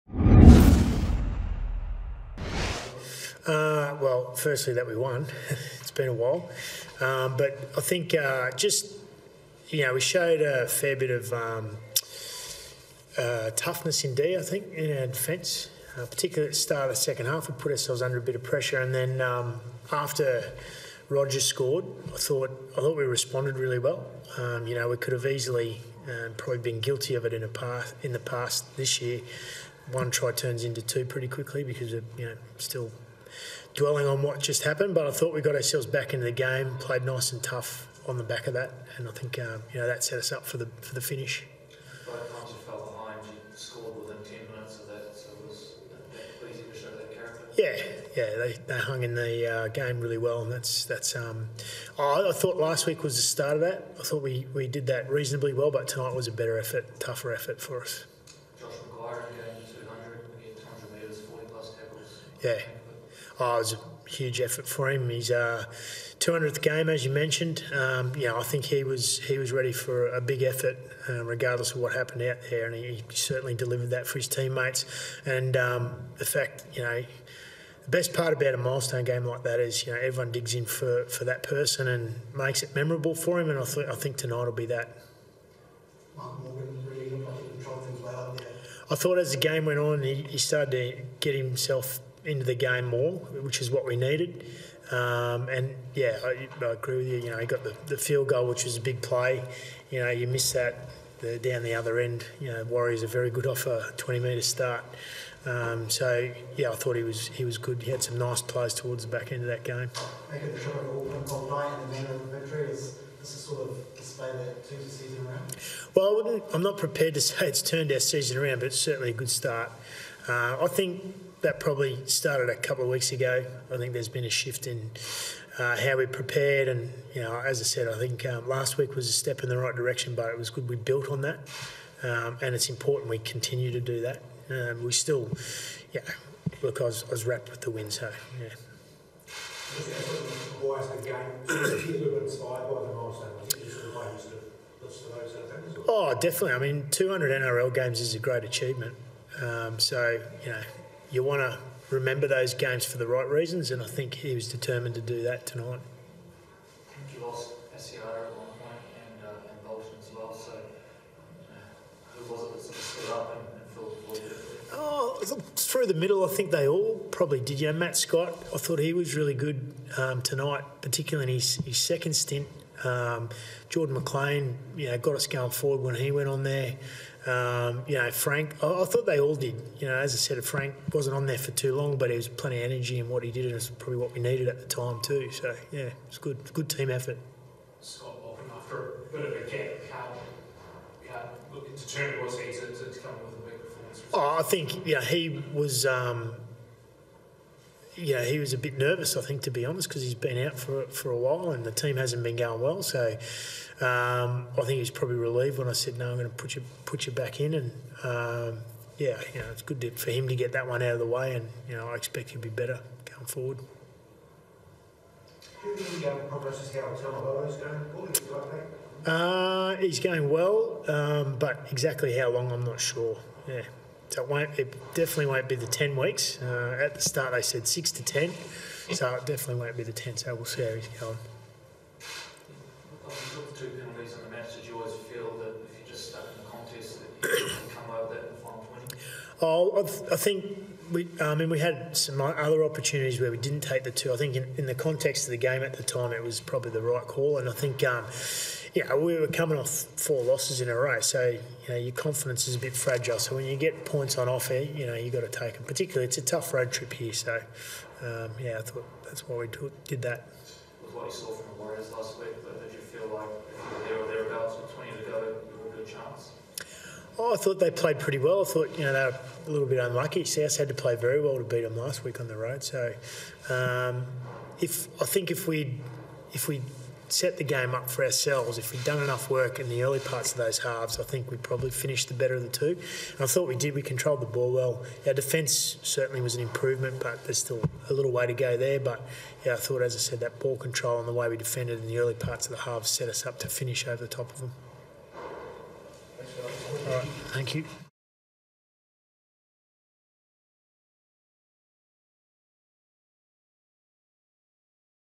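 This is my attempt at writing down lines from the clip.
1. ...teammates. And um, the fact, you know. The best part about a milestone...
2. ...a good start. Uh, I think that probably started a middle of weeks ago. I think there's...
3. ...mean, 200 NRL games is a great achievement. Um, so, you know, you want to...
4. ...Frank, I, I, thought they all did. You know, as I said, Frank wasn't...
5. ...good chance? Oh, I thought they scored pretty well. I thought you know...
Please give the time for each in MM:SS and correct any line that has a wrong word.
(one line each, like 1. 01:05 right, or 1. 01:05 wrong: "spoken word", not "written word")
1. 01:14 right
2. 01:59 wrong: "couple", not "middle"
3. 02:26 right
4. 02:58 right
5. 04:25 wrong: "played", not "scored".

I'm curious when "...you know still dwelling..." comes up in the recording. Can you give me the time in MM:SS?
00:32.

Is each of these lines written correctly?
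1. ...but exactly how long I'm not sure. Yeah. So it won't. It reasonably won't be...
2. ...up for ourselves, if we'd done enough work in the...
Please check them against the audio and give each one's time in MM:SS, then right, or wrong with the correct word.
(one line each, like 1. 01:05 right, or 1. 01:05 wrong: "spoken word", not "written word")
1. 03:41 wrong: "definitely", not "reasonably"
2. 04:37 right.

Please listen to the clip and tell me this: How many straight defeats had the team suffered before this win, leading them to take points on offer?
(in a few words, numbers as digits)
4.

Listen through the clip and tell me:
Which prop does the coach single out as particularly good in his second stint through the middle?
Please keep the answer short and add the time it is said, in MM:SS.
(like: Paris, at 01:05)
Matt Scott, at 02:47.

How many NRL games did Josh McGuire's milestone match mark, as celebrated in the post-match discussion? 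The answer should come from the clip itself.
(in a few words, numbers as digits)
200.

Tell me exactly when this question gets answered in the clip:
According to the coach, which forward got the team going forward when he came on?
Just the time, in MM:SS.
02:53.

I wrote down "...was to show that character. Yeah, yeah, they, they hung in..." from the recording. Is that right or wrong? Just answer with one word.
right.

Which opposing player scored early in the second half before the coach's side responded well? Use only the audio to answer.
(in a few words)
Roger.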